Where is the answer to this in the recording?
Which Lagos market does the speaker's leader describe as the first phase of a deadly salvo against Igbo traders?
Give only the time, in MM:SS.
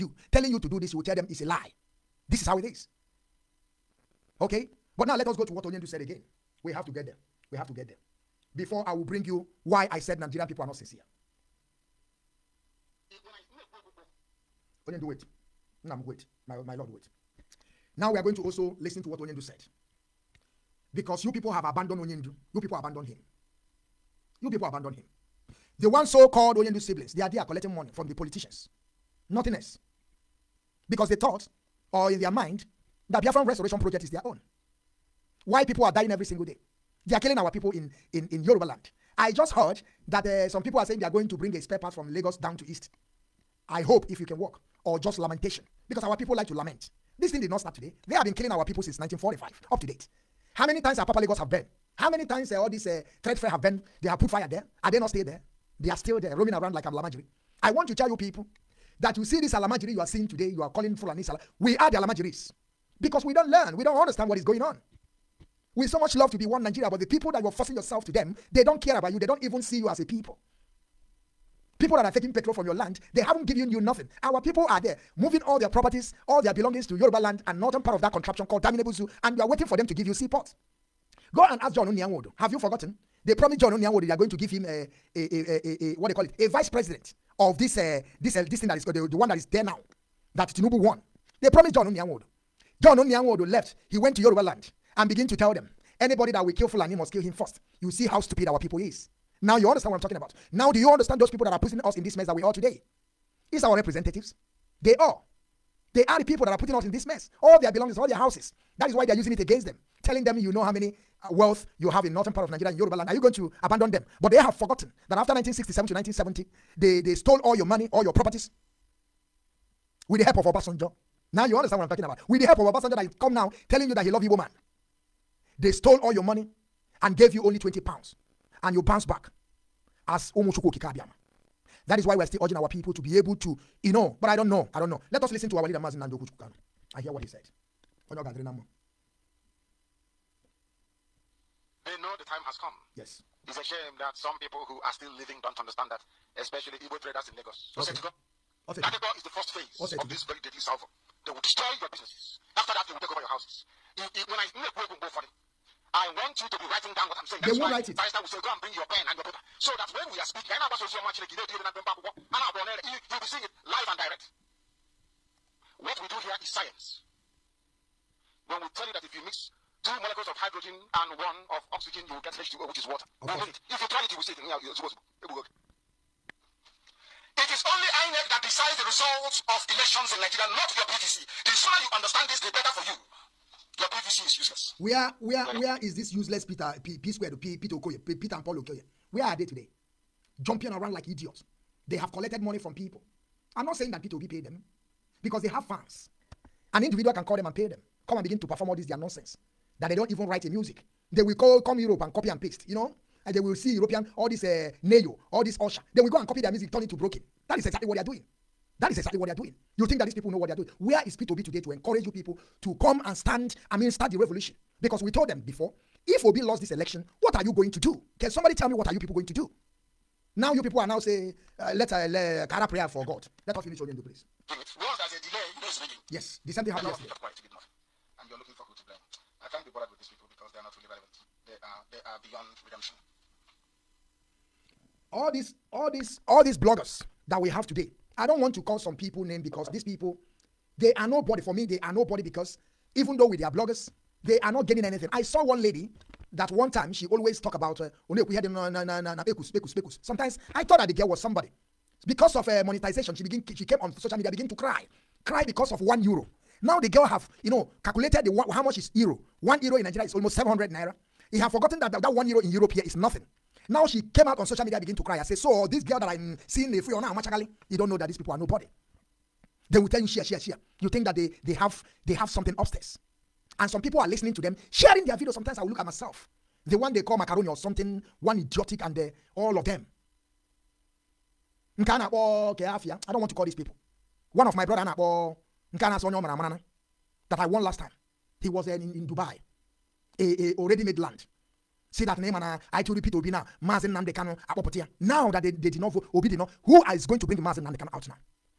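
02:28.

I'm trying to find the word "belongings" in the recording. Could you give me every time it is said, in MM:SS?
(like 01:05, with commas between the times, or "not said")
01:16, 01:47.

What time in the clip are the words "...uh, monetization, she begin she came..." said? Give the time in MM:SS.
04:12.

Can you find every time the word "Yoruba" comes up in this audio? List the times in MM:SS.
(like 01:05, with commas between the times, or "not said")
00:38, 01:16, 01:34, 01:52.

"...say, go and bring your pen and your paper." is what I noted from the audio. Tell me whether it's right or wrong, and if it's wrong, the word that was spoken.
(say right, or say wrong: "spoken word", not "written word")
right.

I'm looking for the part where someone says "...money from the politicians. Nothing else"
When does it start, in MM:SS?
00:27.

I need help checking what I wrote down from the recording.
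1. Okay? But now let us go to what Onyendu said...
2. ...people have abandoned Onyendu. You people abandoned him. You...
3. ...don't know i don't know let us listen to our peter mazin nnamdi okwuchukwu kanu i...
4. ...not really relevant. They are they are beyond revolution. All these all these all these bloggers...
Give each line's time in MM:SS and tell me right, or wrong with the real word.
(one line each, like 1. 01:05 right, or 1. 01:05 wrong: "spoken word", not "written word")
1. 00:04 right
2. 00:21 right
3. 02:14 wrong: "leader", not "peter"
4. 03:50 wrong: "redemption", not "revolution".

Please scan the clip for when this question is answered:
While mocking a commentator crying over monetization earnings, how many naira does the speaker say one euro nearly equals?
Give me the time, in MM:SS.
04:20.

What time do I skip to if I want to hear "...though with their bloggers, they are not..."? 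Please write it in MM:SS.
04:03.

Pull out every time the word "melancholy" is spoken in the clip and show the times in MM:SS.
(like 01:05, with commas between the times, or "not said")
not said.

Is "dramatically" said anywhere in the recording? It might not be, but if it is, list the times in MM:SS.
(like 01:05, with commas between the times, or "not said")
not said.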